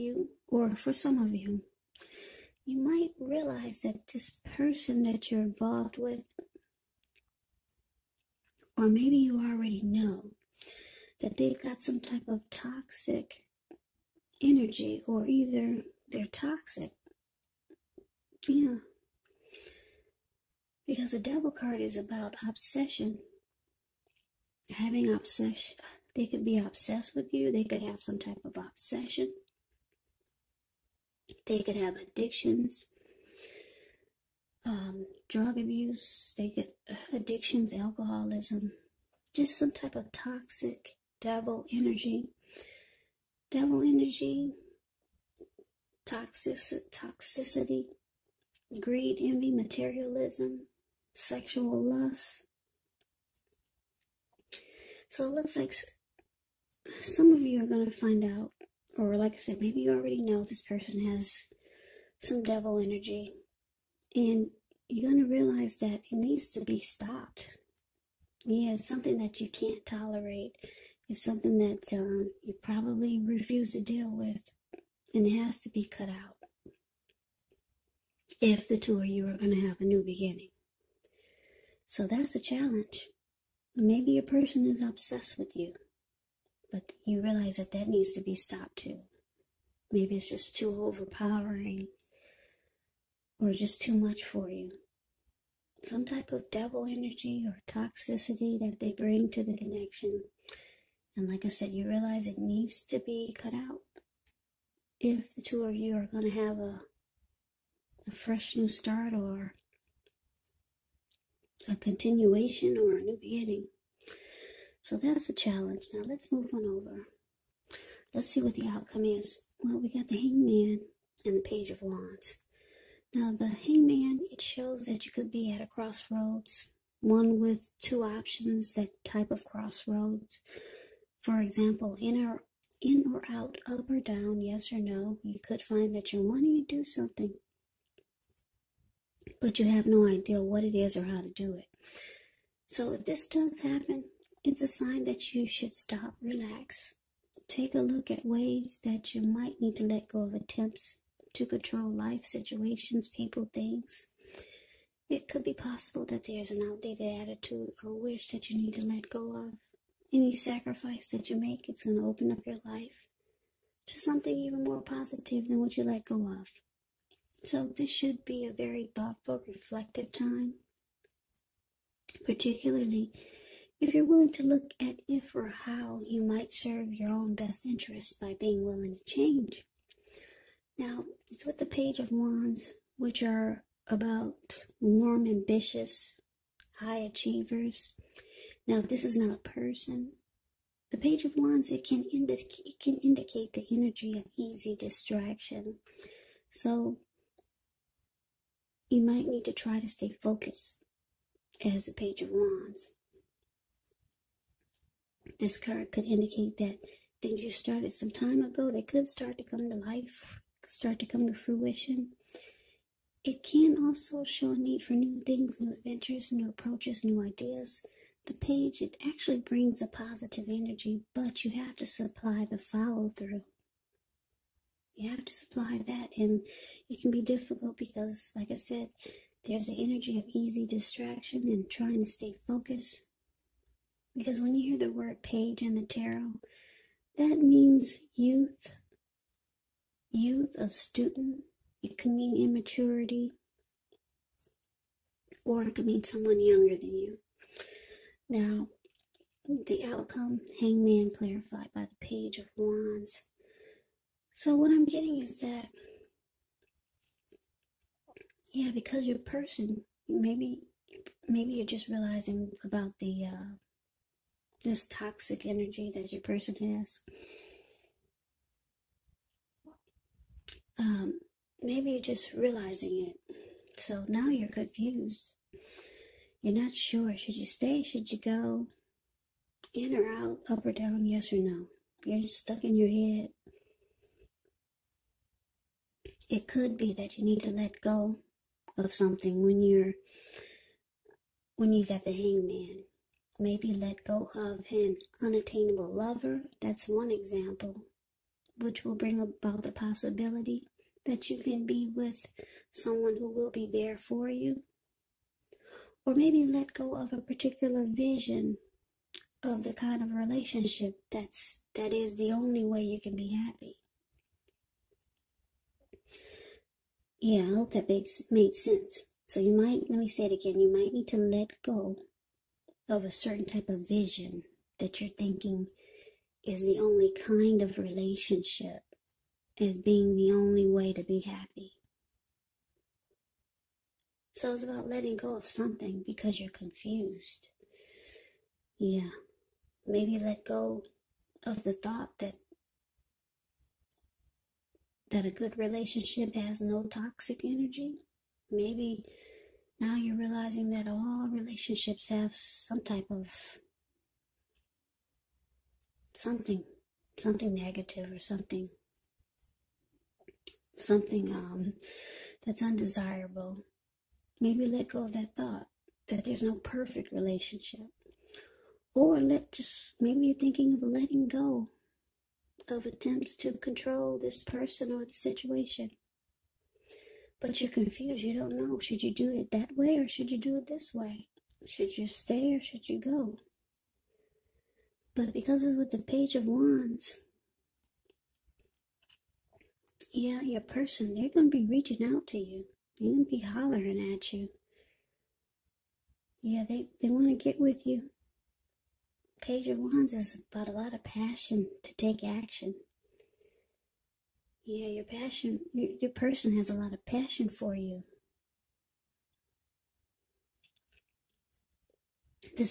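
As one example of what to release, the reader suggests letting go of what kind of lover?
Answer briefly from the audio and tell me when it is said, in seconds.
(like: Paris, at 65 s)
An unattainable lover, at 295 s.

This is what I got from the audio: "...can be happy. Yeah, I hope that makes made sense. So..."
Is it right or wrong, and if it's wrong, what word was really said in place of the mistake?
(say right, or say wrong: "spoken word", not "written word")
right.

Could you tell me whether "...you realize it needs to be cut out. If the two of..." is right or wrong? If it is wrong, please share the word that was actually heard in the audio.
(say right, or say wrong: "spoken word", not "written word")
right.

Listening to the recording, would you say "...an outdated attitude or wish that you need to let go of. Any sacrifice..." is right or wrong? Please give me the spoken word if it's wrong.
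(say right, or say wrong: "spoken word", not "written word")
right.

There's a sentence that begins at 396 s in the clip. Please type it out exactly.
Yeah, they, they want to get with you.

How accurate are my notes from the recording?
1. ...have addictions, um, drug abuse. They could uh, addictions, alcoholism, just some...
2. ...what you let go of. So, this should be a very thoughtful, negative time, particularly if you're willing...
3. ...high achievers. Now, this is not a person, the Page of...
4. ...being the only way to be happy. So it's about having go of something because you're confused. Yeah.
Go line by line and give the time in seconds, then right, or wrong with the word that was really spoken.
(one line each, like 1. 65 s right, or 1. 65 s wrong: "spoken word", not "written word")
1. 31 s right
2. 165 s wrong: "reflective", not "negative"
3. 186 s right
4. 329 s wrong: "letting", not "having".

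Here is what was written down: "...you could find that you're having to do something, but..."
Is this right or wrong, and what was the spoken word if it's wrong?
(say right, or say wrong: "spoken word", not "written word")
wrong: "wanting", not "having".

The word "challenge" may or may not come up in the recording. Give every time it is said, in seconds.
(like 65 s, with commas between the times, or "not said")
82 s, 115 s.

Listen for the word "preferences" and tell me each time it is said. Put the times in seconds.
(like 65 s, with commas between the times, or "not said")
not said.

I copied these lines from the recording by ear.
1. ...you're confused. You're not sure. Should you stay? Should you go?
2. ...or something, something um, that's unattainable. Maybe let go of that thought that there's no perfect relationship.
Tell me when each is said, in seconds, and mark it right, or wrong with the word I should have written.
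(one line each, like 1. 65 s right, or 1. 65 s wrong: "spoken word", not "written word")
1. 274 s right
2. 358 s wrong: "undesirable", not "unattainable".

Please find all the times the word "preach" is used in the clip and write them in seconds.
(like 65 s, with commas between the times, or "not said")
not said.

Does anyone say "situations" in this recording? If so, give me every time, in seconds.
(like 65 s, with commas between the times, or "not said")
152 s, 375 s.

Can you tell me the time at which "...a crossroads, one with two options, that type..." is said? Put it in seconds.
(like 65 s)
125 s.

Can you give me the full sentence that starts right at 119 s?
Well, we got the hangman and the page of wands.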